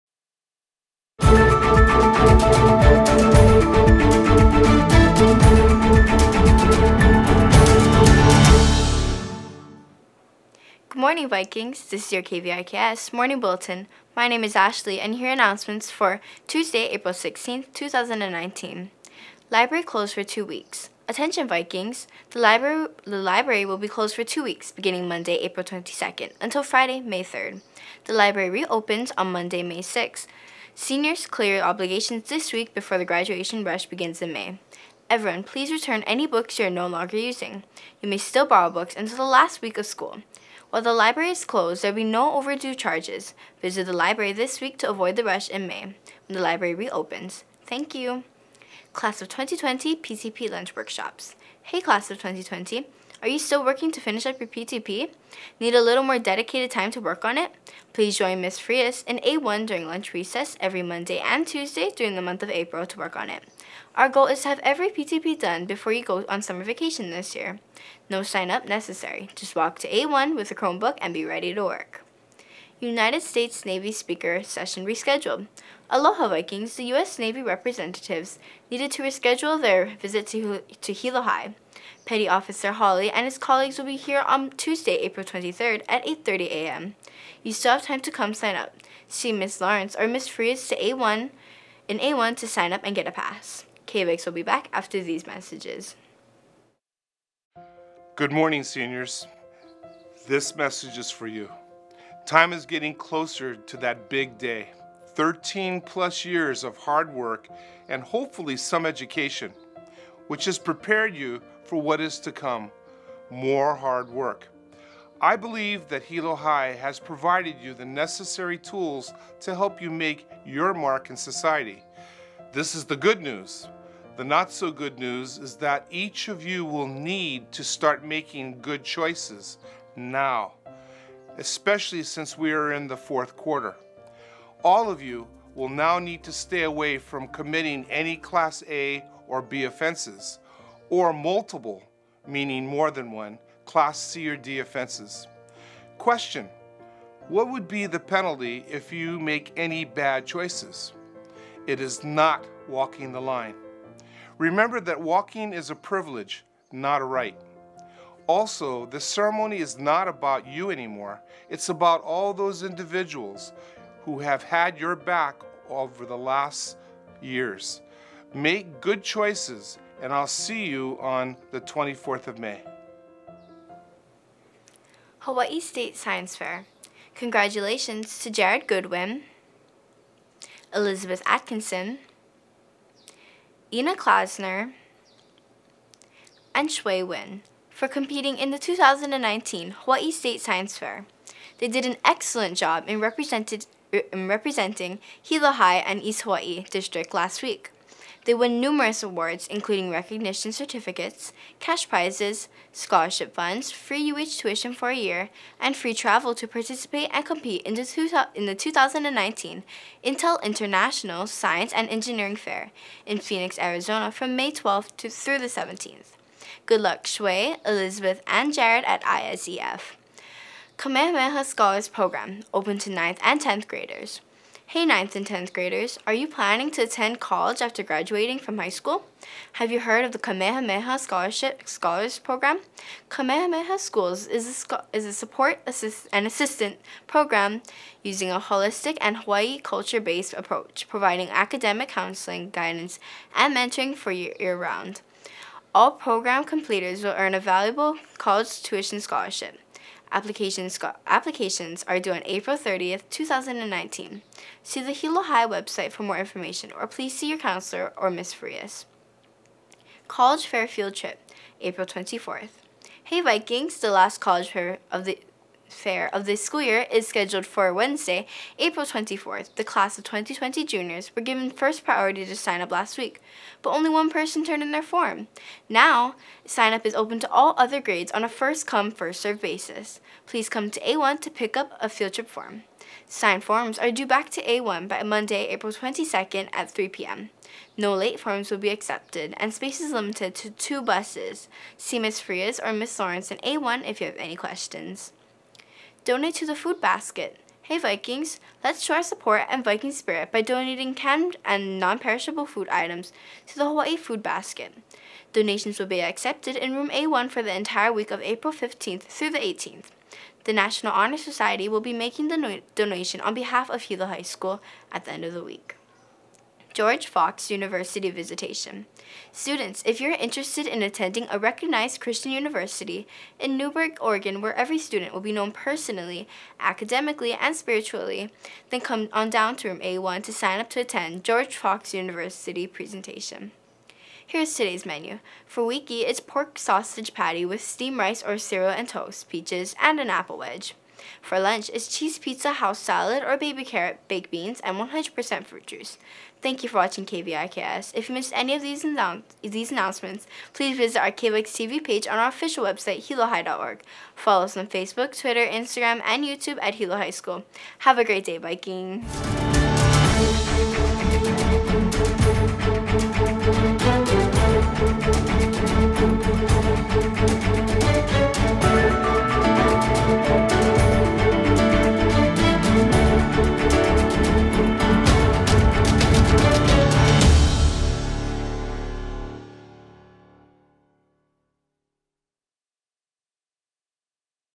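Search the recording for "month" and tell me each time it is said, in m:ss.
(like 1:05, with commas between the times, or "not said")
1:02.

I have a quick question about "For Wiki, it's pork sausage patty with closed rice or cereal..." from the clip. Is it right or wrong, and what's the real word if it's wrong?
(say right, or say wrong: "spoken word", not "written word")
wrong: "steamed", not "closed".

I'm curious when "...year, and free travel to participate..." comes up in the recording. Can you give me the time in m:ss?
3:24.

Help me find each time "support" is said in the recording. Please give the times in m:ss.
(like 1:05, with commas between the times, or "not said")
3:55, 4:59.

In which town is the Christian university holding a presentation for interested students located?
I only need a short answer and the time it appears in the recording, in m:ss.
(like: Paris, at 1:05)
Newberg, Oregon, at 5:23.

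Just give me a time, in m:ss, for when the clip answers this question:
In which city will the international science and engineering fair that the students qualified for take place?
3:33.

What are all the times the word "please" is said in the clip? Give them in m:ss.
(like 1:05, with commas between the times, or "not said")
0:35, 0:57, 4:16, 4:40, 5:50.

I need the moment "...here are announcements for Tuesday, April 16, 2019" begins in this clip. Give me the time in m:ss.
0:15.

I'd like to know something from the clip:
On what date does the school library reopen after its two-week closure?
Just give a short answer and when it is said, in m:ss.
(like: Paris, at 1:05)
Monday, May 6th, at 0:29.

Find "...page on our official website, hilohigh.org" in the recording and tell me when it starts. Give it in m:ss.
5:51.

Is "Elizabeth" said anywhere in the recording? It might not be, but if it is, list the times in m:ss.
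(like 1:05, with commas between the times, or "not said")
3:00, 3:37.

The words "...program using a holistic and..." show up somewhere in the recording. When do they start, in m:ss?
3:57.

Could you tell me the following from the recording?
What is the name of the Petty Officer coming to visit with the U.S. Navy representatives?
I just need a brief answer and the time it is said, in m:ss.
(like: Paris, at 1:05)
Petty Officer Holly, at 1:22.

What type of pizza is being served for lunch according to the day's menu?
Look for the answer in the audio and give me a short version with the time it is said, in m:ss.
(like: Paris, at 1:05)
Cheese pizza, at 5:41.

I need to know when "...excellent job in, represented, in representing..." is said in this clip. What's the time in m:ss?
3:12.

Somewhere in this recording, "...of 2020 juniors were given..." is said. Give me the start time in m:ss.
4:29.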